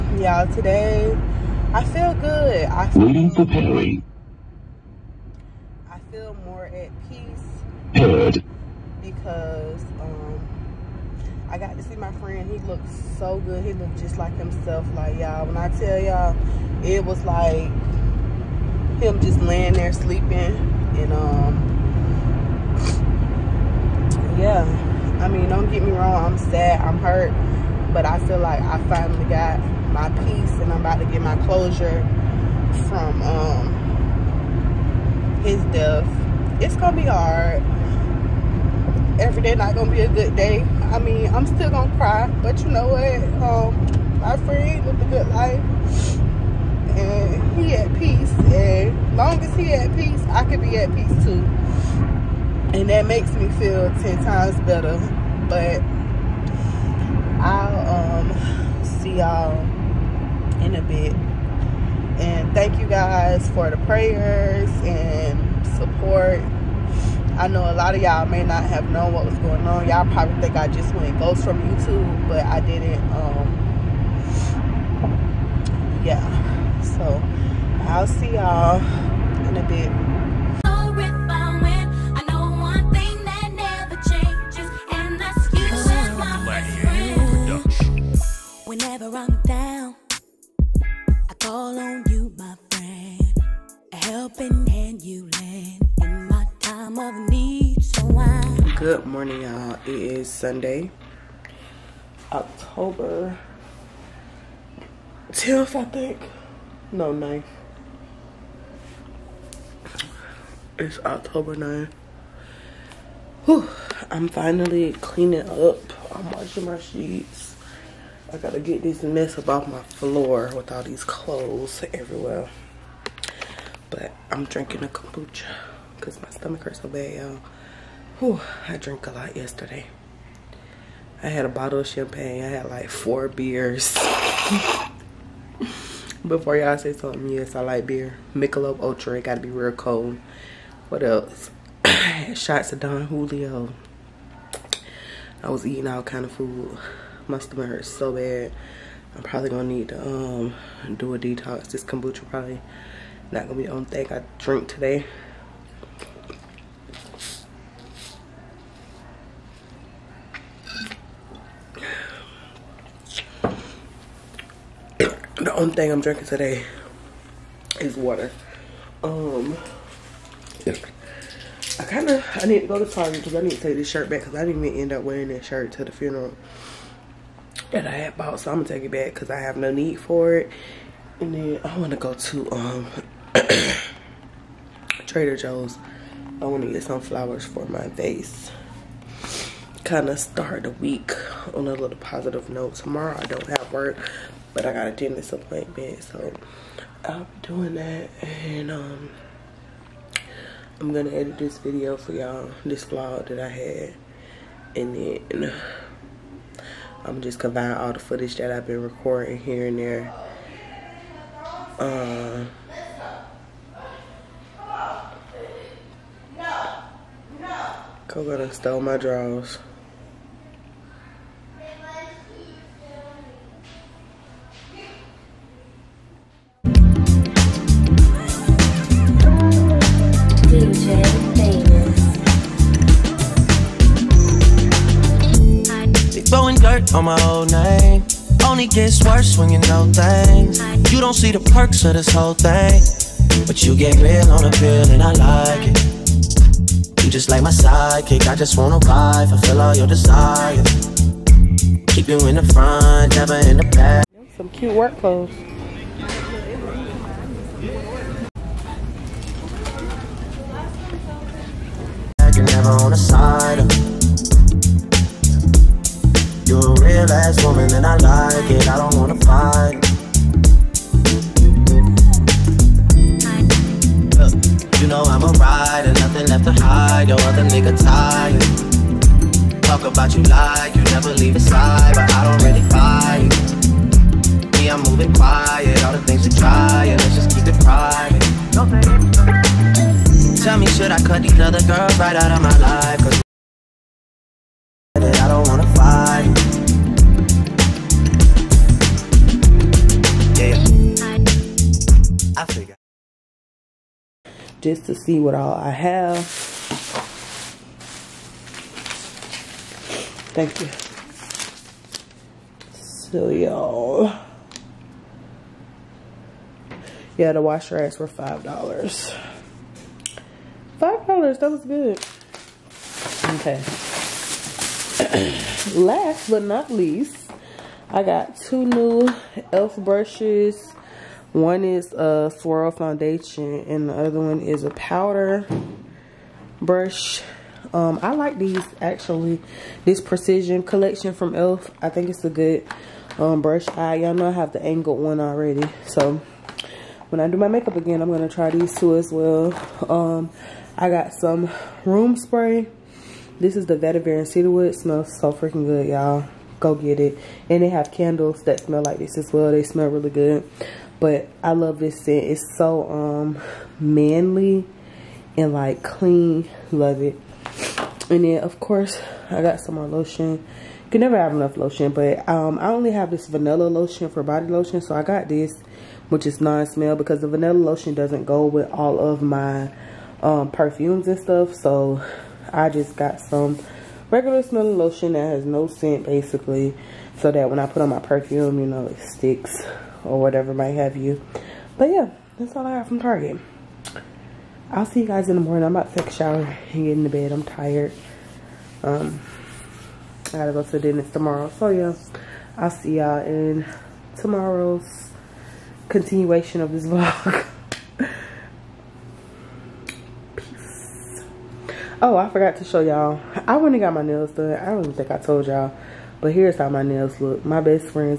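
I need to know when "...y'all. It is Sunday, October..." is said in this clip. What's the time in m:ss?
1:39.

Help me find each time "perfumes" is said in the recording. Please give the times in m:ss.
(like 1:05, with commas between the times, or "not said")
6:20, 6:27.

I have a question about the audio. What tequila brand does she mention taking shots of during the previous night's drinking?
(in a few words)
Don Julio.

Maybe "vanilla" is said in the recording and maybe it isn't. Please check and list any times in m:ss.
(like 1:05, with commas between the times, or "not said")
6:13, 6:17.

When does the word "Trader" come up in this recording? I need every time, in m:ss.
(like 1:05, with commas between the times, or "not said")
3:05.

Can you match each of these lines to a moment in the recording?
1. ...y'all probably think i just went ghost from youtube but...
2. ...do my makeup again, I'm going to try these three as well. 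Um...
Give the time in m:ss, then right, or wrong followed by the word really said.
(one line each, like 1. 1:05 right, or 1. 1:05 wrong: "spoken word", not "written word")
1. 1:09 right
2. 5:47 wrong: "two", not "three".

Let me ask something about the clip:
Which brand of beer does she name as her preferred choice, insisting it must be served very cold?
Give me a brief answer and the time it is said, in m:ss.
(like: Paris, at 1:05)
Michelob Ultra, at 2:18.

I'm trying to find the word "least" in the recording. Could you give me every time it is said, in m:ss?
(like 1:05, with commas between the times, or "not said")
5:26.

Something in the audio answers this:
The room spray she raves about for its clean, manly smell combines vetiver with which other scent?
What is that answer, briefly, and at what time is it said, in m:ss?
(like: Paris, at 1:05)
cedarwood, at 5:54.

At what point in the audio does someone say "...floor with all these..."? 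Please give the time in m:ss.
1:59.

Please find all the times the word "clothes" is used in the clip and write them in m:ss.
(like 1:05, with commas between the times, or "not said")
2:01, 4:14.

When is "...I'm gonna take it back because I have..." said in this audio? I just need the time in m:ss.
2:58.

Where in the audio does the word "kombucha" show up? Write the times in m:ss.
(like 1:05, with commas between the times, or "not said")
2:04, 2:31.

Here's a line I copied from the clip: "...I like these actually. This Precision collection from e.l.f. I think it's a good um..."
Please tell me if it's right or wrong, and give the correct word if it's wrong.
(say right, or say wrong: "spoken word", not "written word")
right.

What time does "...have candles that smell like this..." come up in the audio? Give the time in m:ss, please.
5:57.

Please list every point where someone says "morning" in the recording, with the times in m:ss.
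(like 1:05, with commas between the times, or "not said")
1:39, 6:35.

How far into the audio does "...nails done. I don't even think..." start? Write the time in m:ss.
6:54.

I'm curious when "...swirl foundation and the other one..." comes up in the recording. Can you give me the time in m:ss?
5:32.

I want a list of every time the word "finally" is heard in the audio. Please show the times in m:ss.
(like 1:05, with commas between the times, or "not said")
0:28, 1:54.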